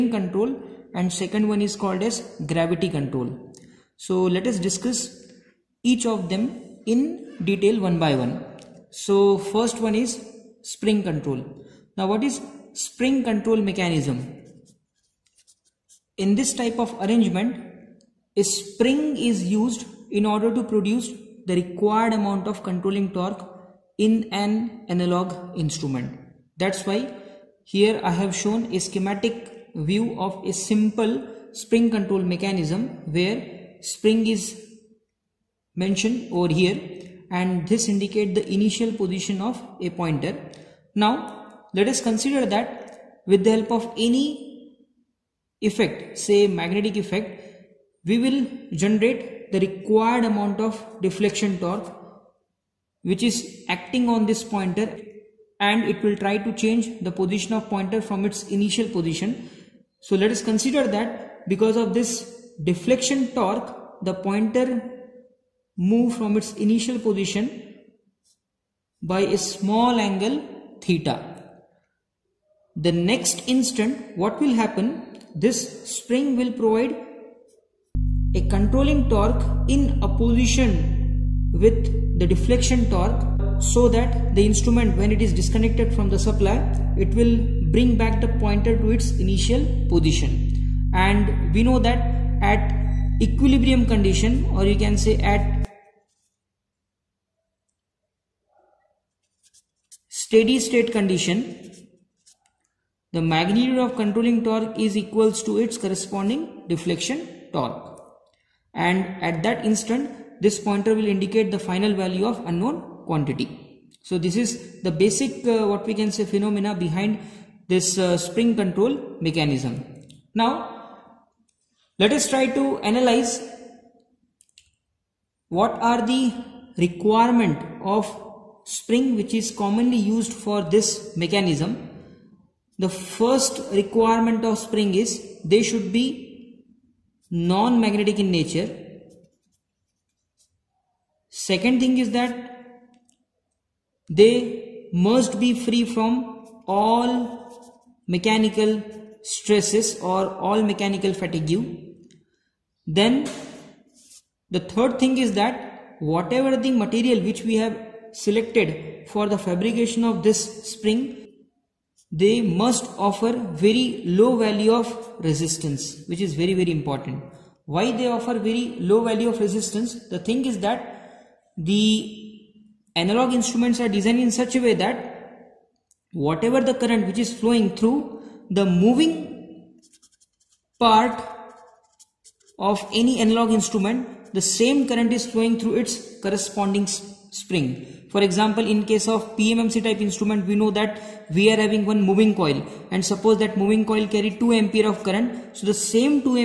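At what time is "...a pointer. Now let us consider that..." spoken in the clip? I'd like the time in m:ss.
0:39.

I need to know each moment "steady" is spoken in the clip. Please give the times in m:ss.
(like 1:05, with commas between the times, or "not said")
1:40.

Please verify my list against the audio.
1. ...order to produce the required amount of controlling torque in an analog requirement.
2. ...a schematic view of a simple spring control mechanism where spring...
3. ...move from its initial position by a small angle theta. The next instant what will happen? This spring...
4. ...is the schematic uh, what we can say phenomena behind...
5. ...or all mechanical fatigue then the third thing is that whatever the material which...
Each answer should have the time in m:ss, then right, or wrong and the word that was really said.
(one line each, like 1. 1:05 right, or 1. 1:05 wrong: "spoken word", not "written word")
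1. 0:20 wrong: "instrument", not "requirement"
2. 0:28 right
3. 1:05 right
4. 1:54 wrong: "basic", not "schematic"
5. 2:30 right.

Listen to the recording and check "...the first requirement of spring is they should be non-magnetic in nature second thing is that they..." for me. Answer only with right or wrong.
right.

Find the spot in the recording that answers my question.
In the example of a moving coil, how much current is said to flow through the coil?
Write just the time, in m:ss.
3:14.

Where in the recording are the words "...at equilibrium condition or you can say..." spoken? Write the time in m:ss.
1:32.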